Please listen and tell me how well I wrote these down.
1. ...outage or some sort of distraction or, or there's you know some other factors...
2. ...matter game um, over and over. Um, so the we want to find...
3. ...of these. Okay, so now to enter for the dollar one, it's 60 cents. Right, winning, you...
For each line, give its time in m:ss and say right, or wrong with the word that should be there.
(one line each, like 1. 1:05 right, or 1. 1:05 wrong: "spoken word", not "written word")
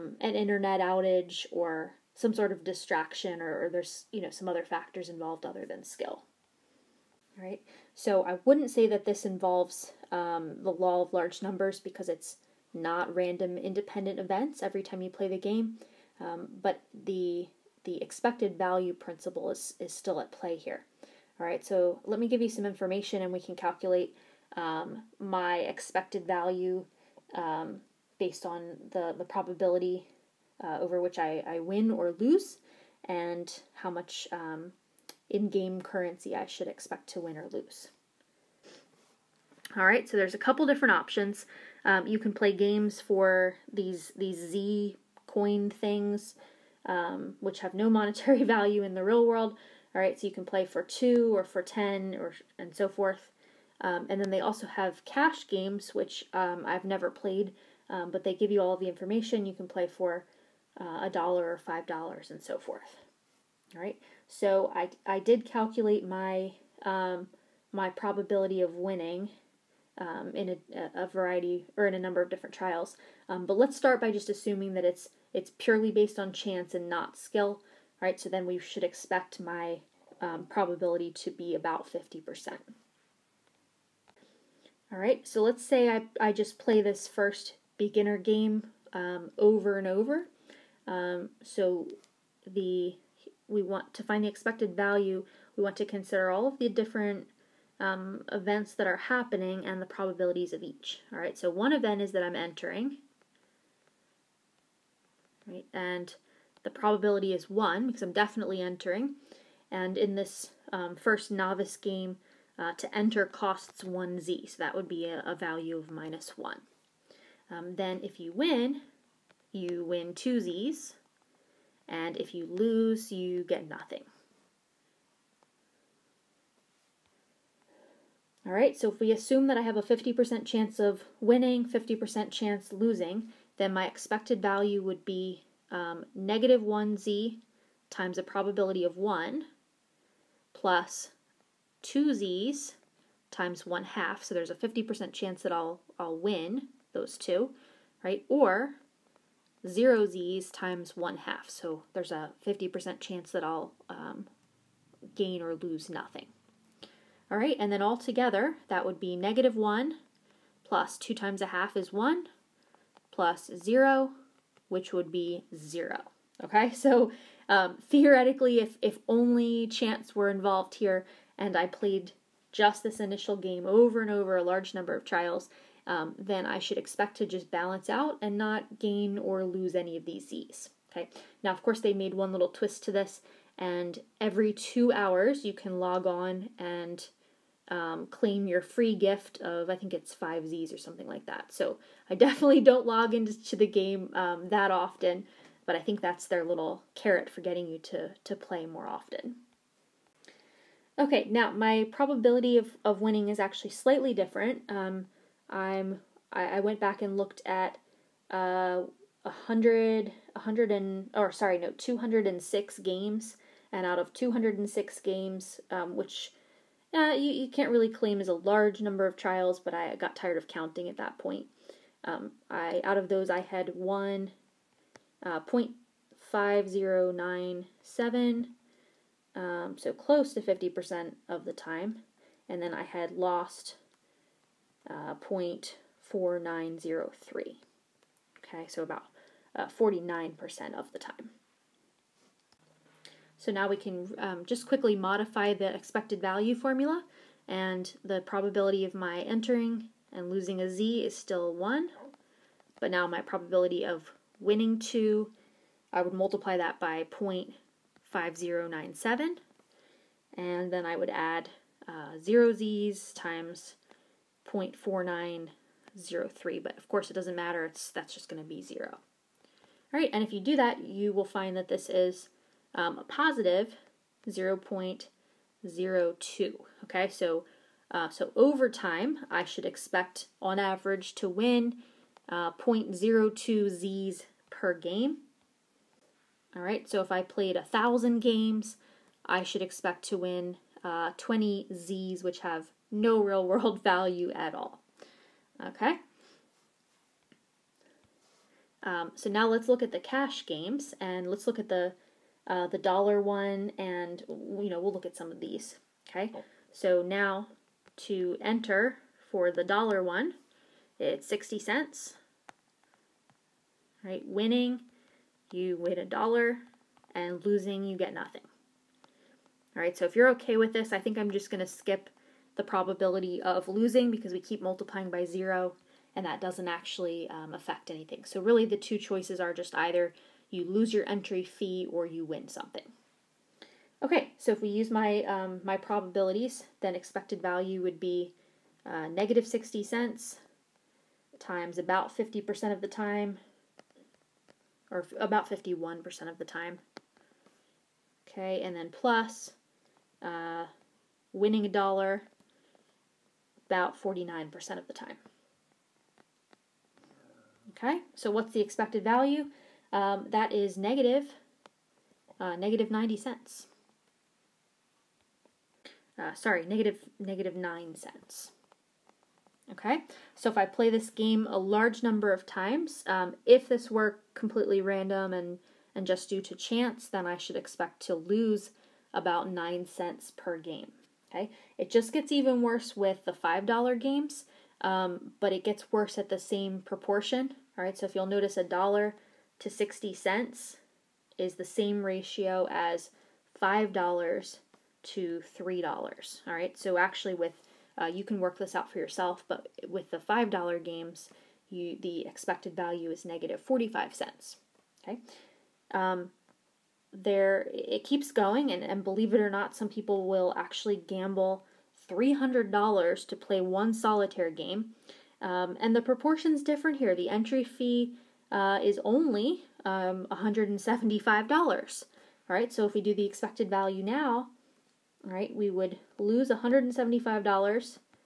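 1. 0:00 right
2. 1:27 wrong: "beginner", not "matter"
3. 5:05 right.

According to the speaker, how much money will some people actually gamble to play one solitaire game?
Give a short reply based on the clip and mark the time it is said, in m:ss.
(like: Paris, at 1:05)
$300, at 6:52.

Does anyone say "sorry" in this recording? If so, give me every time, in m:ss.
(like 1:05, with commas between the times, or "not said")
3:31, 6:06.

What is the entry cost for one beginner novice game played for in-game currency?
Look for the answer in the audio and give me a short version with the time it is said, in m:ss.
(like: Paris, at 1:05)
1z, at 1:53.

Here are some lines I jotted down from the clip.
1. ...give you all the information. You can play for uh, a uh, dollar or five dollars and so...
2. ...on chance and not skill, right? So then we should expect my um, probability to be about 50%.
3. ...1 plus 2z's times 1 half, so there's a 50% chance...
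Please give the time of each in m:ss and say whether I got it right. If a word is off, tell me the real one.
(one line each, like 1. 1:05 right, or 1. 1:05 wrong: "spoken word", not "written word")
1. 0:58 right
2. 1:16 right
3. 2:18 right.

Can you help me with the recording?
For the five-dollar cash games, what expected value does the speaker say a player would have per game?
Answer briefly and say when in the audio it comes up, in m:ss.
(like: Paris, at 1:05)
negative 45 cents, at 6:43.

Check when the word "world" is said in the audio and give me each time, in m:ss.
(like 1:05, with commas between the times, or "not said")
0:49, 4:53.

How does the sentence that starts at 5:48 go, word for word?
Okay, and then plus uh, winning a dollar about 49% of the time.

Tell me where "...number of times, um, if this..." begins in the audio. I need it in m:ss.
6:12.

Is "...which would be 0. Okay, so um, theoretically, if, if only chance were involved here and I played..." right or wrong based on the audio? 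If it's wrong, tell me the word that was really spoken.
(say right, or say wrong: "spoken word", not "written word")
right.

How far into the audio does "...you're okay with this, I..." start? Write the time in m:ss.
5:20.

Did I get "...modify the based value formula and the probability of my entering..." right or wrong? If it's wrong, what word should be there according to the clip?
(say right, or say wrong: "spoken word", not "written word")
wrong: "expected", not "based".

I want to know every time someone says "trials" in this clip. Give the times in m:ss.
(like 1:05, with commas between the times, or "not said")
1:12, 2:55, 3:39.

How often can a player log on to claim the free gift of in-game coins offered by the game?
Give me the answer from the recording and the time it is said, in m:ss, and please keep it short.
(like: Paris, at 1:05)
every two hours, at 3:04.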